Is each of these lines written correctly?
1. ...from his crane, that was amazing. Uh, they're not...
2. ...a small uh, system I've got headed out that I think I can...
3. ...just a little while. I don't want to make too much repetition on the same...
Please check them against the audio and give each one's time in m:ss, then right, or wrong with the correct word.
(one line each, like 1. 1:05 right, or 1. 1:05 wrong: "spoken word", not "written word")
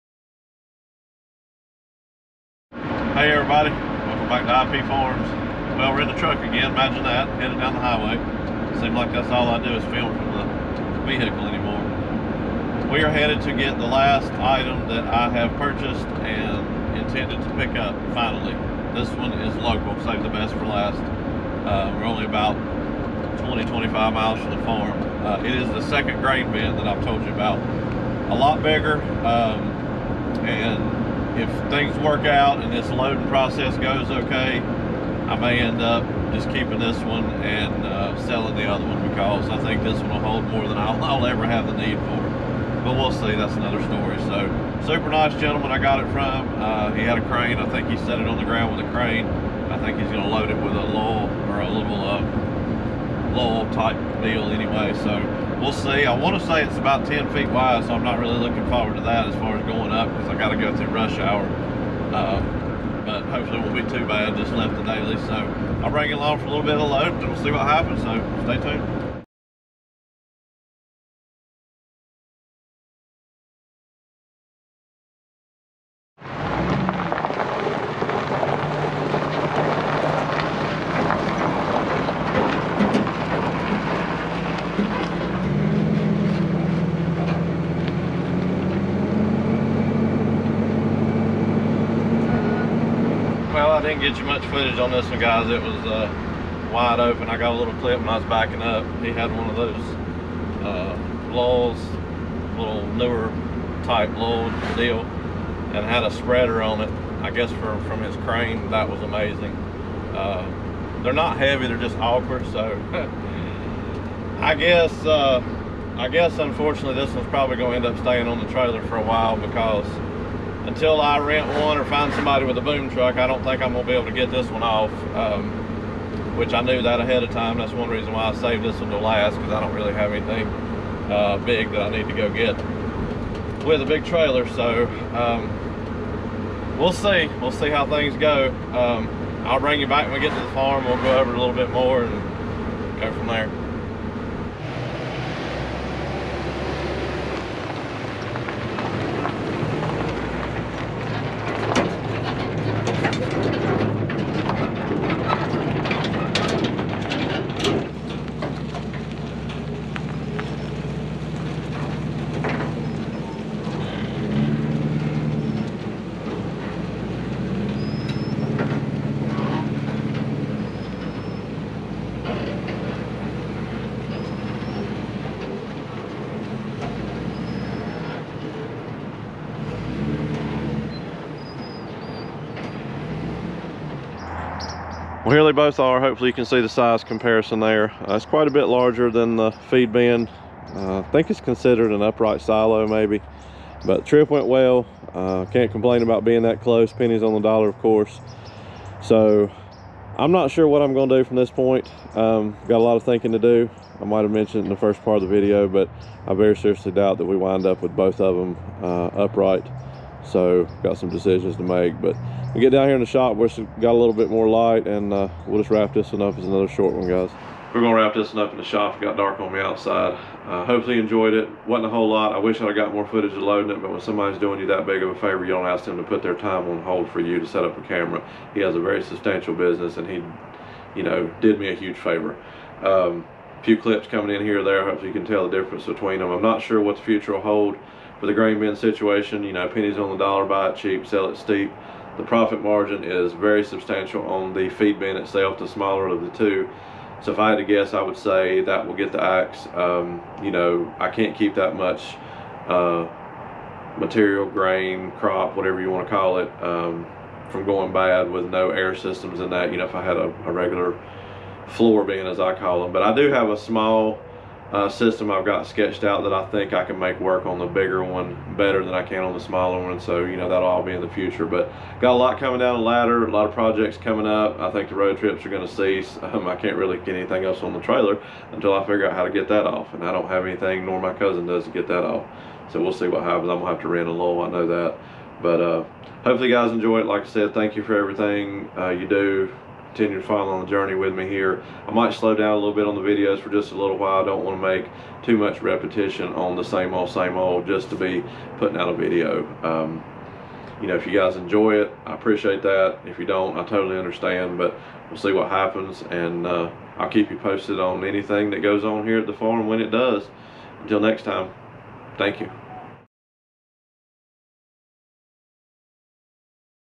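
1. 1:47 right
2. 4:23 wrong: "sketched", not "headed"
3. 4:53 right.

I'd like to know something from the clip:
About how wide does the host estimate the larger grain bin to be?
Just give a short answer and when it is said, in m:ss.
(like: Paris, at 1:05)
10 feet, at 0:57.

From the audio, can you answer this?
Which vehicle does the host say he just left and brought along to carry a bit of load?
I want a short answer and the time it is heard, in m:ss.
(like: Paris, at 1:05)
The daily, at 1:04.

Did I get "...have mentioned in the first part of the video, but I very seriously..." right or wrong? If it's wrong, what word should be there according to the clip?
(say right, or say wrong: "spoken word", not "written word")
right.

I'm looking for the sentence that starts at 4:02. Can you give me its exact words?
The profit margin is very substantial on the feed bin itself, the smaller of the two.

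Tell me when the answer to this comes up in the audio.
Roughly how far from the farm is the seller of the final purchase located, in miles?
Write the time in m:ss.
0:23.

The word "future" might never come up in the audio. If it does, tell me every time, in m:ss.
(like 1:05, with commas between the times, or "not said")
3:57, 4:31.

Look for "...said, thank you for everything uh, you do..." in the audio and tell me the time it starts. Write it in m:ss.
4:47.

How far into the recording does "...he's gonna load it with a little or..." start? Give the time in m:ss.
0:49.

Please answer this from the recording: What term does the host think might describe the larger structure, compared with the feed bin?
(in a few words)
Upright silo.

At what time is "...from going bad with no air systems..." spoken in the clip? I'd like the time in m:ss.
4:17.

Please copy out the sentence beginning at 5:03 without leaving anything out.
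If you don't, I totally understand, but we'll see what happens.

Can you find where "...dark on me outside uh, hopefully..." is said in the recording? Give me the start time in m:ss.
3:39.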